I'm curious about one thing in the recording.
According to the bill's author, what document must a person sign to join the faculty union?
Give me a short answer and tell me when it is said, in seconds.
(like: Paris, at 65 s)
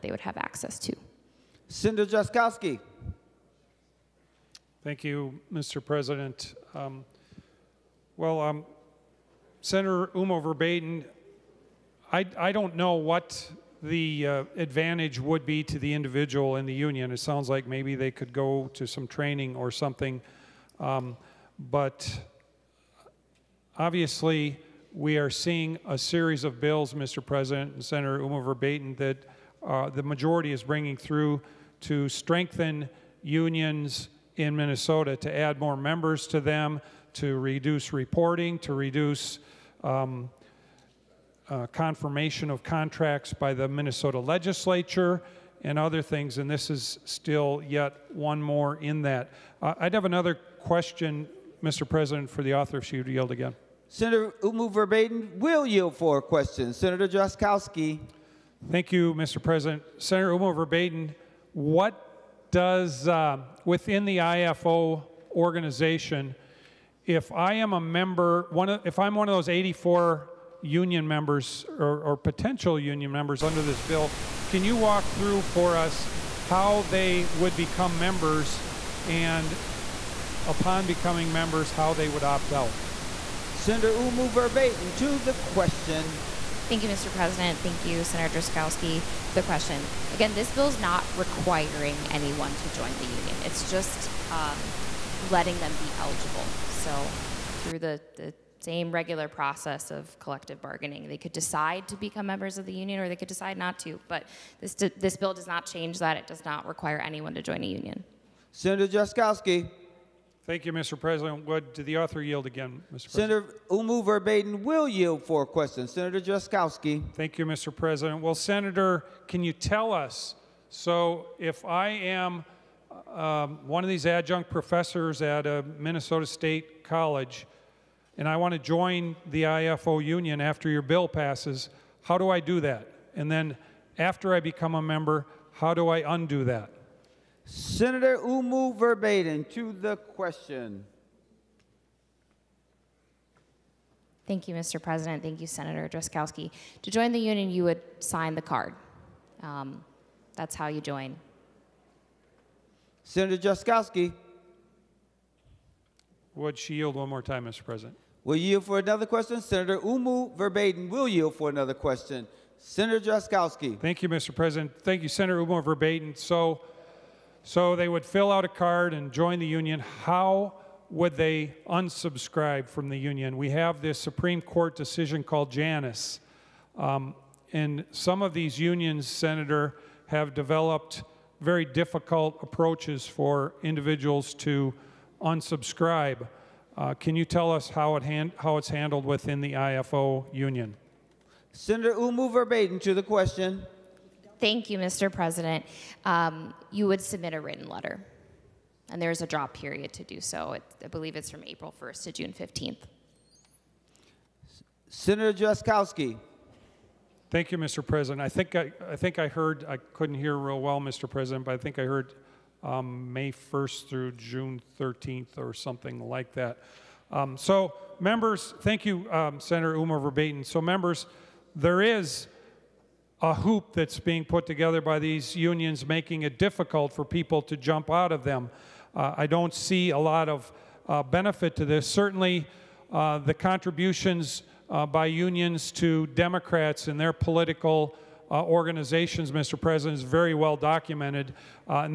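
the card, at 147 s.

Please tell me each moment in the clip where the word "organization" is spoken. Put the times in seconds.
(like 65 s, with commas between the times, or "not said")
65 s, 238 s.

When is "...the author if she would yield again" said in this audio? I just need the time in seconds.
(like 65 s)
52 s.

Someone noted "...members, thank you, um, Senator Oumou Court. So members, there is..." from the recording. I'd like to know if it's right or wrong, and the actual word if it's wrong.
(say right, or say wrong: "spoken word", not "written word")
wrong: "Verbeten", not "Court".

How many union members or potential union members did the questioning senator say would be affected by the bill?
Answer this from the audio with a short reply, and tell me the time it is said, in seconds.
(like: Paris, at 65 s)
84, at 69 s.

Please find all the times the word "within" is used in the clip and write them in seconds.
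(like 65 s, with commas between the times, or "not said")
63 s, 189 s.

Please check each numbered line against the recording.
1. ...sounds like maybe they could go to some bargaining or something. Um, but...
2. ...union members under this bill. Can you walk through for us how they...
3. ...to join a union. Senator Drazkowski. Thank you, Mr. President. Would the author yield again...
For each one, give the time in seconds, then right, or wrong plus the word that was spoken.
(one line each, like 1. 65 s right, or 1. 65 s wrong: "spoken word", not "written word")
1. 17 s wrong: "training", not "bargaining"
2. 72 s right
3. 107 s right.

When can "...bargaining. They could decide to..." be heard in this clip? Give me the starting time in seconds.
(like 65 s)
100 s.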